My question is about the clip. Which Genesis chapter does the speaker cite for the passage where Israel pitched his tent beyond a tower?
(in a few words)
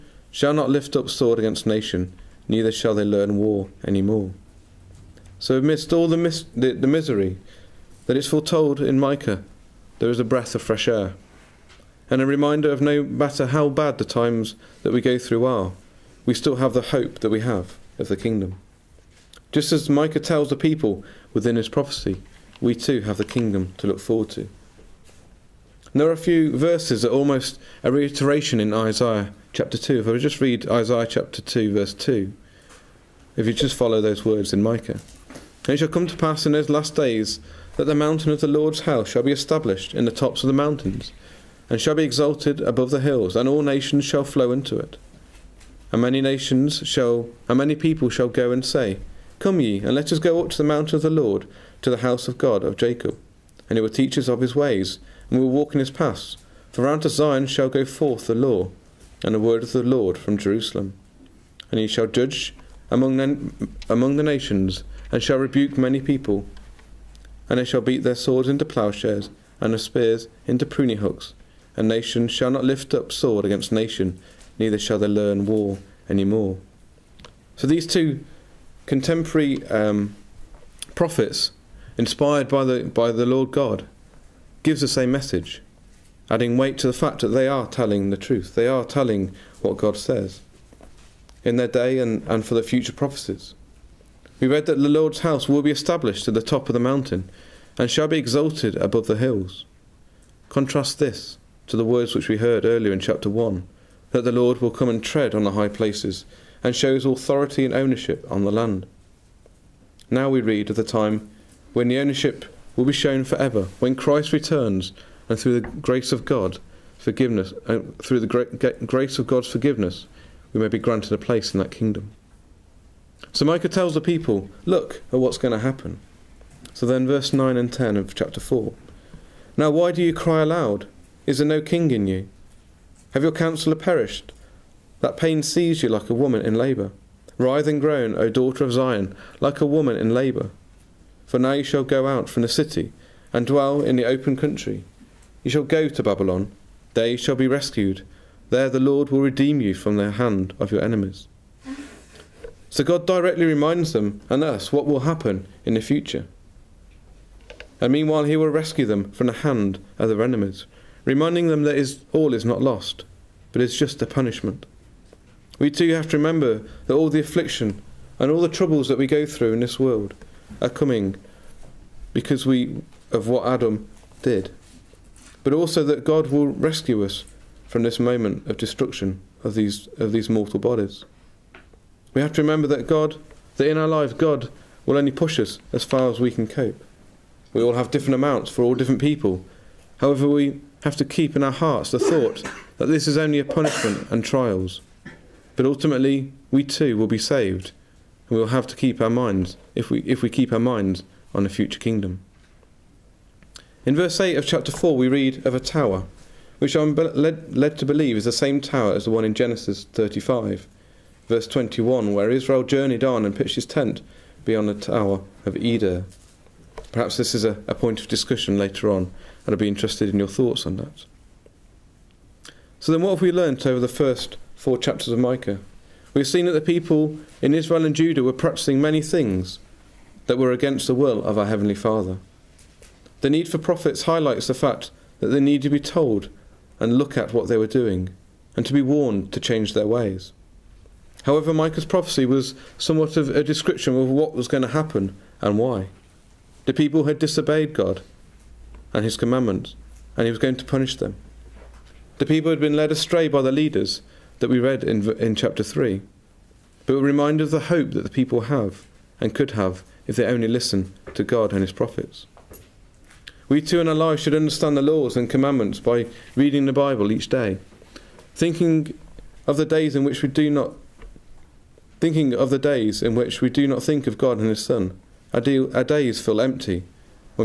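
Chapter 35.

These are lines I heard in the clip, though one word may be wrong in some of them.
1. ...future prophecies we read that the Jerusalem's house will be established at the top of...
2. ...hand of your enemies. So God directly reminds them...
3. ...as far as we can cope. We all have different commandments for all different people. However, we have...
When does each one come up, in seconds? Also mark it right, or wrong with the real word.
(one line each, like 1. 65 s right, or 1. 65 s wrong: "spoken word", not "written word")
1. 92 s wrong: "Lord", not "Jerusalem"
2. 150 s right
3. 185 s wrong: "amounts", not "commandments".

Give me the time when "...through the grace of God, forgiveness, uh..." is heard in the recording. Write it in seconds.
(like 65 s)
115 s.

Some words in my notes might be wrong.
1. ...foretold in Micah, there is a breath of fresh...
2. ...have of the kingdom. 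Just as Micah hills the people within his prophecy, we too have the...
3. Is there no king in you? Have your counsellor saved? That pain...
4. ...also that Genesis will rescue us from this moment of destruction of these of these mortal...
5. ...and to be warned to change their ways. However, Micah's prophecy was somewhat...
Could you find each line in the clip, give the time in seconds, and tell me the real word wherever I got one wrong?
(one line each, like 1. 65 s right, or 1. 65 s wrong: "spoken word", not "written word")
1. 8 s right
2. 17 s wrong: "tells", not "hills"
3. 131 s wrong: "perished", not "saved"
4. 175 s wrong: "God", not "Genesis"
5. 238 s right.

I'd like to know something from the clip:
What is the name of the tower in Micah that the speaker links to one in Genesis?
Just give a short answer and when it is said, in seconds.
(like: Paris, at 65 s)
Tower of Eder, at 214 s.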